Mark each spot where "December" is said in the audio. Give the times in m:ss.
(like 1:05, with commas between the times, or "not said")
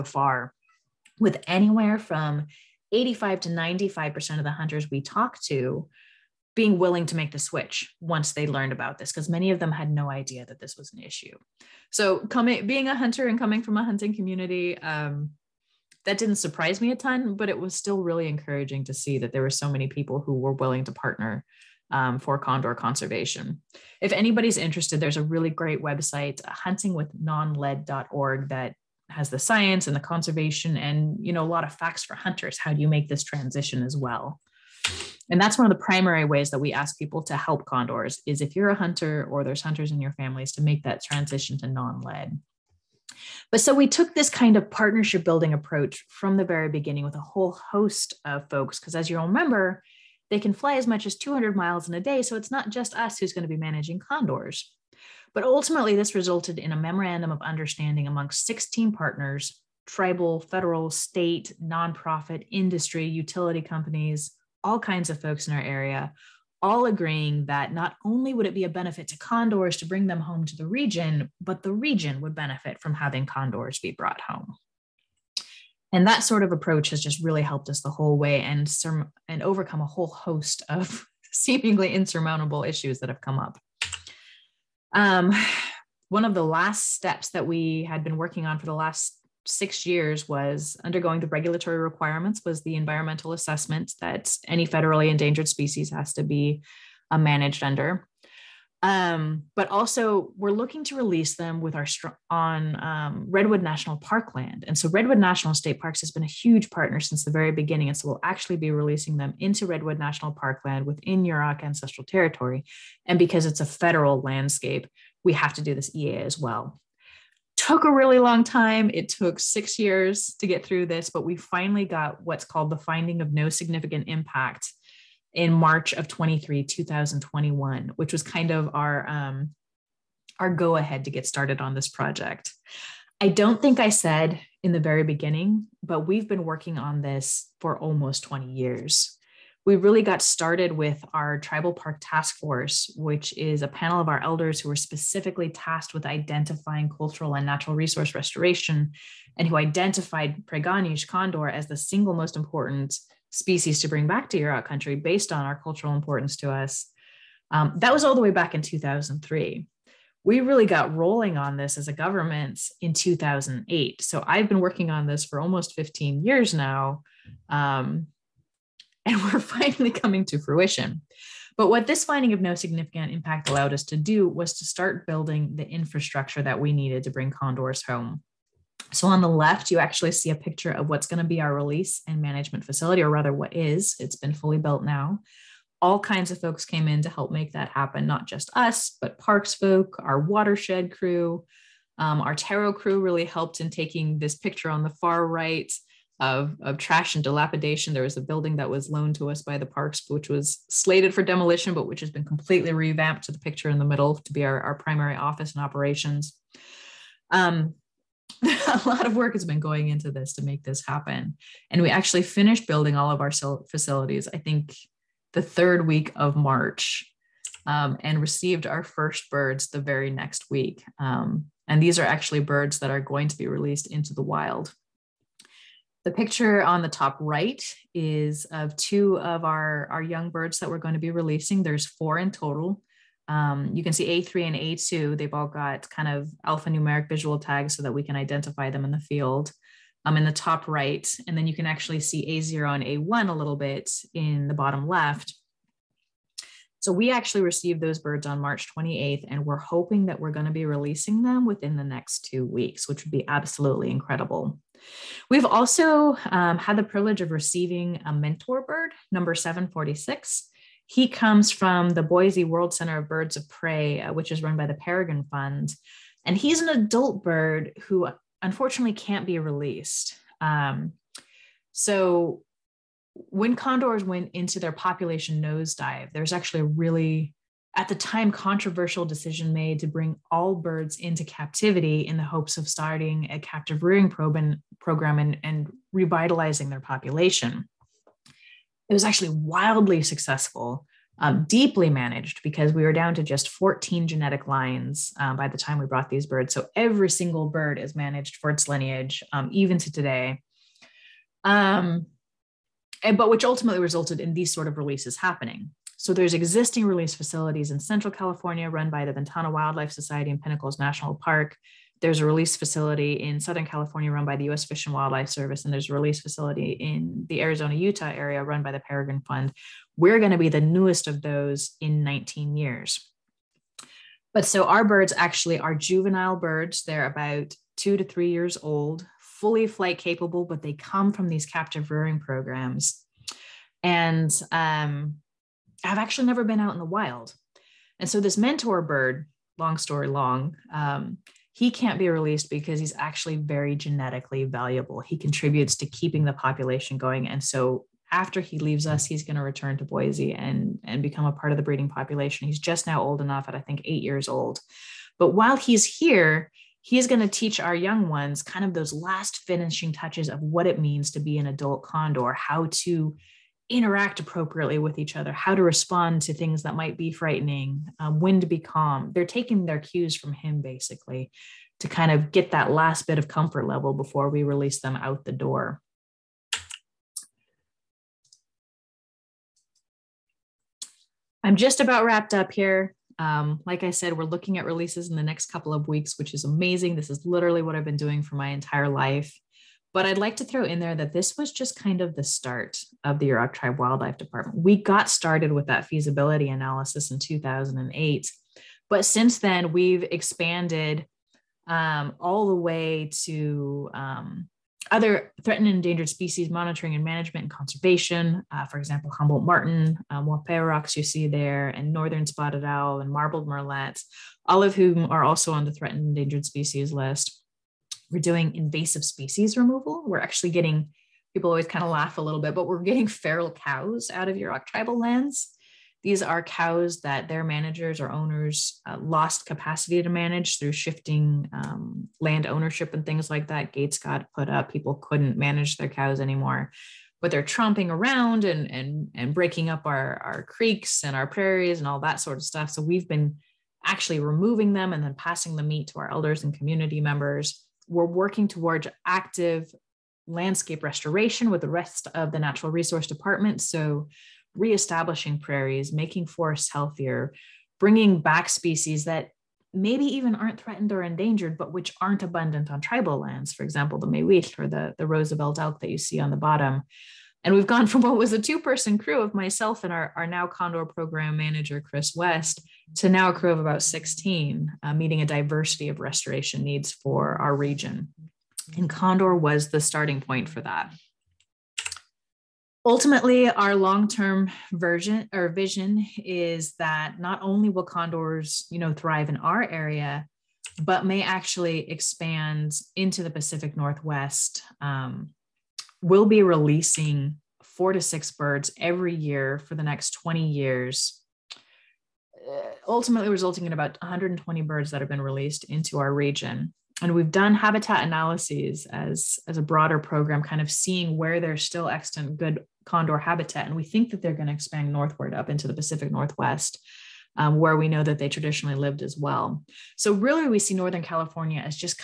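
not said.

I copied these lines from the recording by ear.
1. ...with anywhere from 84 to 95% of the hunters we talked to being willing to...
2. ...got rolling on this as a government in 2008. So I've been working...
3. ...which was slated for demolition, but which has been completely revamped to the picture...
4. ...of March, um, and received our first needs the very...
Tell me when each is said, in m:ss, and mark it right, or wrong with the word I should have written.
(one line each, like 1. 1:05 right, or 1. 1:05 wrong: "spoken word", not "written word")
1. 0:01 wrong: "85", not "84"
2. 2:40 right
3. 3:20 right
4. 3:36 wrong: "birds", not "needs".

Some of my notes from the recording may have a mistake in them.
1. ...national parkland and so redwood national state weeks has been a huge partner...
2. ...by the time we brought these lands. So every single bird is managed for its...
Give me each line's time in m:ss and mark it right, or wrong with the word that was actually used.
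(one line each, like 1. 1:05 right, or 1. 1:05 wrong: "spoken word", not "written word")
1. 1:43 wrong: "parks", not "weeks"
2. 4:55 wrong: "birds", not "lands".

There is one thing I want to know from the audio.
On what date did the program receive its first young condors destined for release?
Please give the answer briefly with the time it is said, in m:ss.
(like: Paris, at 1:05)
March 28, at 4:08.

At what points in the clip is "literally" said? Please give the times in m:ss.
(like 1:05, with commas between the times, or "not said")
6:27.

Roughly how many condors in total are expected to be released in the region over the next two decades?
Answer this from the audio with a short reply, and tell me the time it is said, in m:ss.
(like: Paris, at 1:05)
120, at 8:24.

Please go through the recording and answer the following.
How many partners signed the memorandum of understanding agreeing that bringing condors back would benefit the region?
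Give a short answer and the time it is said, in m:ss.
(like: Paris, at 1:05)
16, at 0:58.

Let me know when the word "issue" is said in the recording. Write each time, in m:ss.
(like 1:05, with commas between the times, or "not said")
0:11, 1:22.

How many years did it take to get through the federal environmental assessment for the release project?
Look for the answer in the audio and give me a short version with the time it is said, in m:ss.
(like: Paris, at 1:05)
6, at 1:58.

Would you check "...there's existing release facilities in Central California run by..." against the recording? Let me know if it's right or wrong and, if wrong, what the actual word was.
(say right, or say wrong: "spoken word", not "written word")
right.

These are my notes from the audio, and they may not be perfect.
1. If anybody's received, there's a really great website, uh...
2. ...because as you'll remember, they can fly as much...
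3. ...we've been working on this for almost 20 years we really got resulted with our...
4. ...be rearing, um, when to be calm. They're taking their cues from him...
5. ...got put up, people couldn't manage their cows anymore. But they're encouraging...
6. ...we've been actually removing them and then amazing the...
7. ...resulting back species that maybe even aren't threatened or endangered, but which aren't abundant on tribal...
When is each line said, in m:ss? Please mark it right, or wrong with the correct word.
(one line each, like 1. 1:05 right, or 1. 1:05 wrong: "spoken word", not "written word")
1. 0:24 wrong: "interested", not "received"
2. 0:48 right
3. 2:16 wrong: "started", not "resulted"
4. 6:06 wrong: "frightening", not "rearing"
5. 7:13 wrong: "tromping", not "encouraging"
6. 7:22 wrong: "passing", not "amazing"
7. 7:37 wrong: "bringing", not "resulting".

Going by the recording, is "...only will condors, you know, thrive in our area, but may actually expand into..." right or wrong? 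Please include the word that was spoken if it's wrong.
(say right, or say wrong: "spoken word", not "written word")
right.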